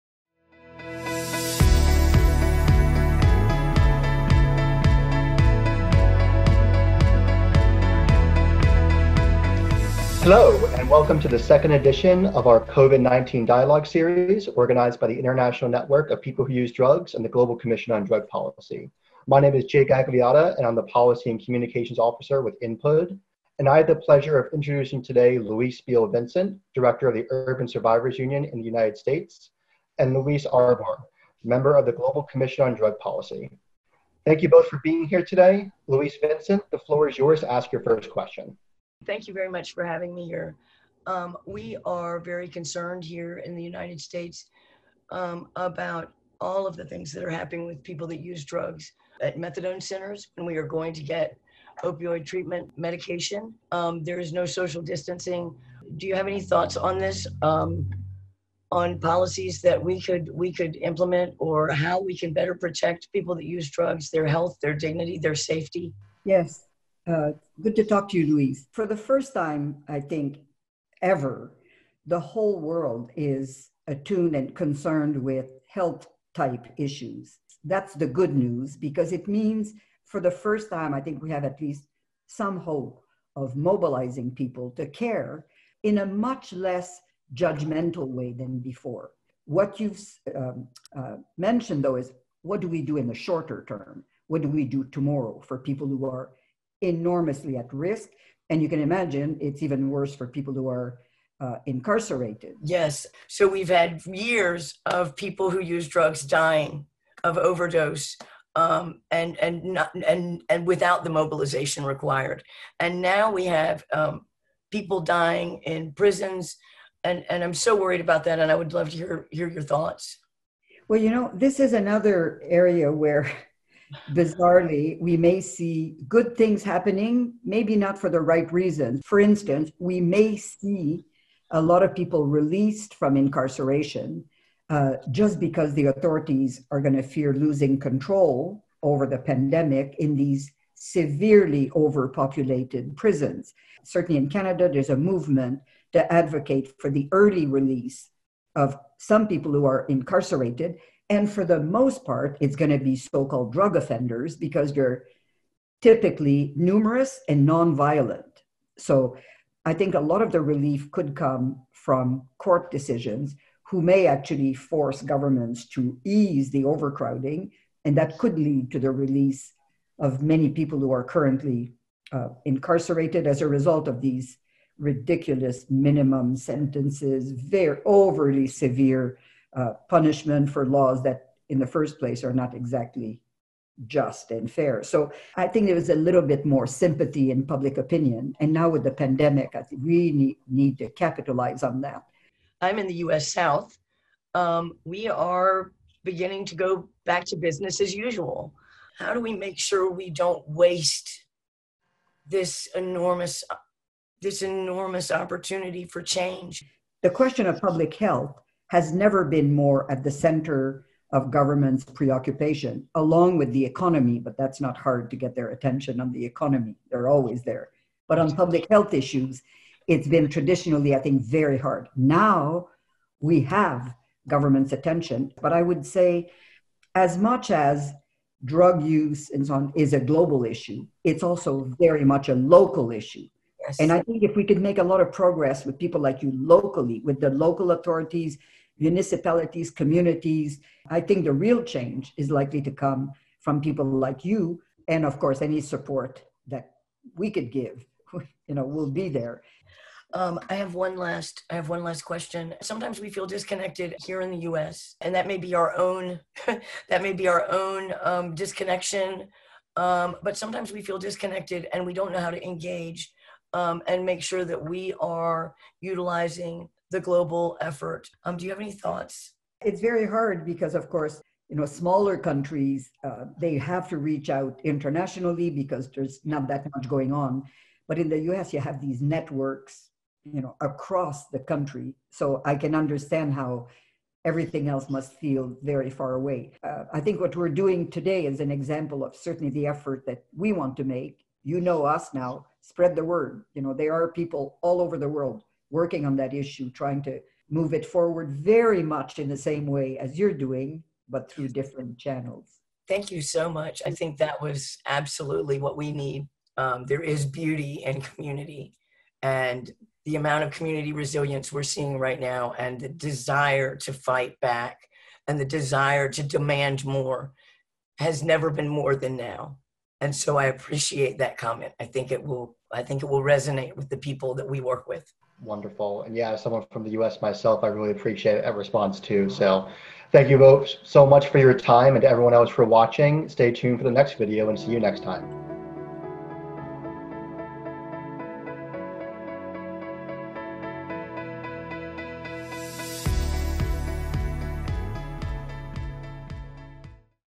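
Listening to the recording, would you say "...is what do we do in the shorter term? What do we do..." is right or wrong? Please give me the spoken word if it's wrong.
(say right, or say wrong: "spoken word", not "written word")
right.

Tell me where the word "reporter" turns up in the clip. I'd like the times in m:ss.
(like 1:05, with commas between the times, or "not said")
not said.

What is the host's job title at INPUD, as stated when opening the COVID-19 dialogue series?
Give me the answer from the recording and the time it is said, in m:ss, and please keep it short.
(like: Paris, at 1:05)
Policy and Communications Officer, at 0:20.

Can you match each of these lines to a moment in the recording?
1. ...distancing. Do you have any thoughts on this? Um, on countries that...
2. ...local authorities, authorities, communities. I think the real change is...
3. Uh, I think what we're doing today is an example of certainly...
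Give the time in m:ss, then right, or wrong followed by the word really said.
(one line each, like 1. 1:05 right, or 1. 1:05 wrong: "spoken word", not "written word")
1. 0:54 wrong: "policies", not "countries"
2. 3:57 wrong: "municipalities", not "authorities"
3. 4:46 right.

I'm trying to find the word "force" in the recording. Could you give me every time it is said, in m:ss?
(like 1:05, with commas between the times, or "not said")
2:44.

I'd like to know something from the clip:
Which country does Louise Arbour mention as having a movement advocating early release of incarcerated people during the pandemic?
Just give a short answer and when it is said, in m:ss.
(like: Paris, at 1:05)
Canada, at 2:24.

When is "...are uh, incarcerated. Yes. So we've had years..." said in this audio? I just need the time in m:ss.
1:40.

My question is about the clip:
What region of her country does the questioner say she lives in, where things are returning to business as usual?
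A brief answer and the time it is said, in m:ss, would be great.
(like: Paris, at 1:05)
US South, at 3:12.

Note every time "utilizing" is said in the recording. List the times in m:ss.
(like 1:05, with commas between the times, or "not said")
4:25.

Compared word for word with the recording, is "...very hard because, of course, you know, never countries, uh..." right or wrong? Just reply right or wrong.
wrong.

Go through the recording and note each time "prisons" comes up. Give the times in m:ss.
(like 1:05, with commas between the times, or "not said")
1:55, 2:22.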